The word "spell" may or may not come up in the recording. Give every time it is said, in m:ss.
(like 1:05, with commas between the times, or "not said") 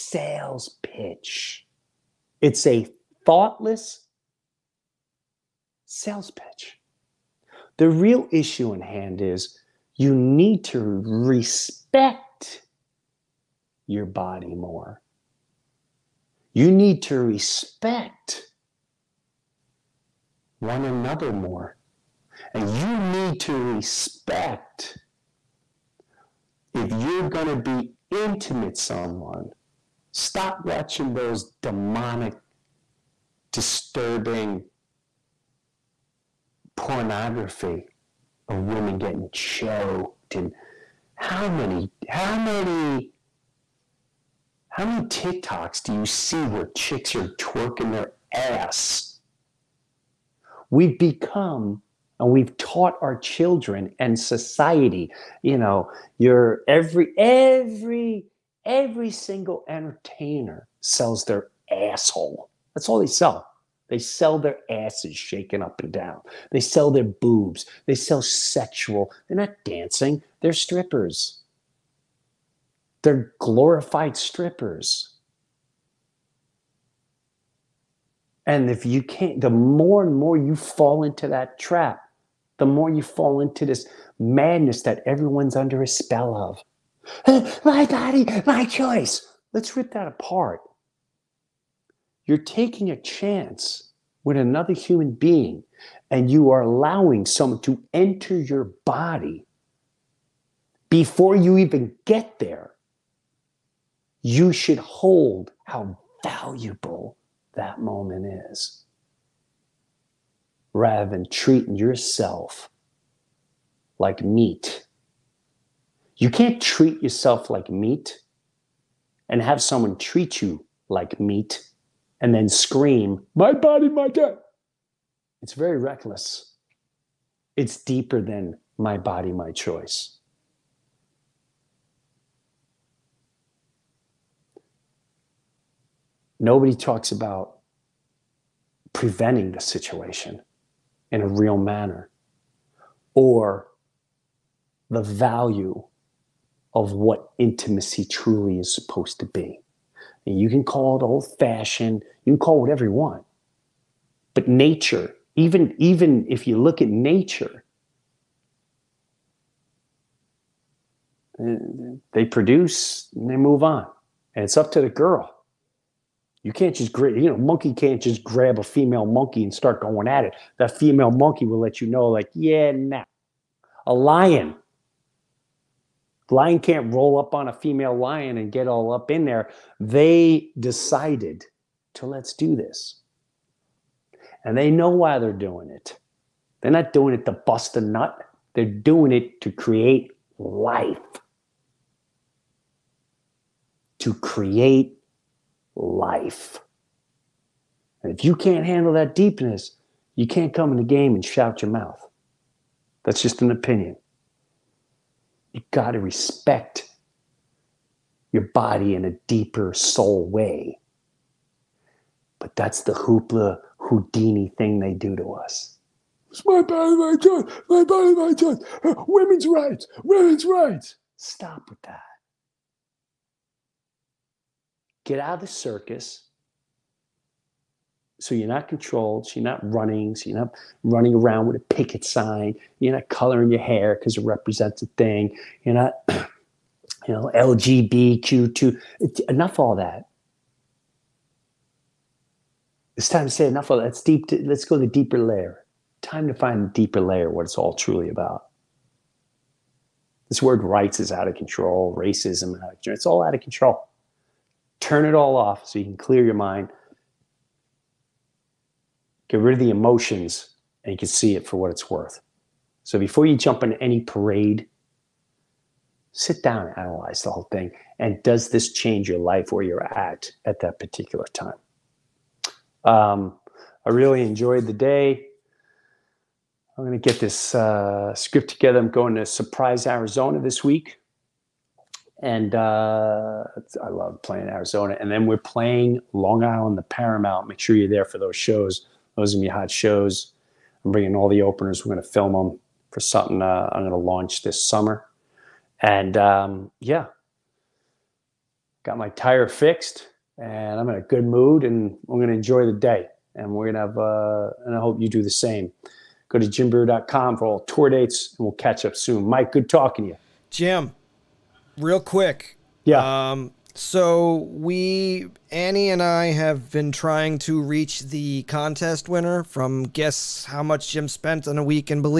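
1:25.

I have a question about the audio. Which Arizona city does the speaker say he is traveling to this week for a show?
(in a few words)
Surprise.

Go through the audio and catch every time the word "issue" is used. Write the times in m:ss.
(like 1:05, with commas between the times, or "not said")
0:08.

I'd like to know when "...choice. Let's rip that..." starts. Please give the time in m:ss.
1:28.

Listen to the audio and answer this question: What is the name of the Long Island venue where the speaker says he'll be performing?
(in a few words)
The Paramount.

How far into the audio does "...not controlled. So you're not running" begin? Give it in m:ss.
3:48.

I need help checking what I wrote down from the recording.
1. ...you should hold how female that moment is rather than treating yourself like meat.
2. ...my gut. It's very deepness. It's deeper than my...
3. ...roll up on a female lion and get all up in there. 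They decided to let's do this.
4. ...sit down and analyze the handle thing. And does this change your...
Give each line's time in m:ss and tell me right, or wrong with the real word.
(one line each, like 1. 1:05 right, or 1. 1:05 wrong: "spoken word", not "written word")
1. 1:44 wrong: "valuable", not "female"
2. 2:03 wrong: "reckless", not "deepness"
3. 2:56 right
4. 4:26 wrong: "whole", not "handle".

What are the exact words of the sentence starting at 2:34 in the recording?
But nature, even, even if you look at nature, eh, they produce and they move on.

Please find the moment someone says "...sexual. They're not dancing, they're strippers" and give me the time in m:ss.
1:08.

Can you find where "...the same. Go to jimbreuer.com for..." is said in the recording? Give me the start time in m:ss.
5:05.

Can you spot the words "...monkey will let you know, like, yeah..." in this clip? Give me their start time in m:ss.
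2:51.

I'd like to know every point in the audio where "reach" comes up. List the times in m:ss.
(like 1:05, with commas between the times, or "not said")
5:17.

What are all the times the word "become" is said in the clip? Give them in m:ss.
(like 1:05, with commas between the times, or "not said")
0:50.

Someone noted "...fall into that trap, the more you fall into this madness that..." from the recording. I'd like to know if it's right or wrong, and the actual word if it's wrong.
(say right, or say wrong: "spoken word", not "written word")
right.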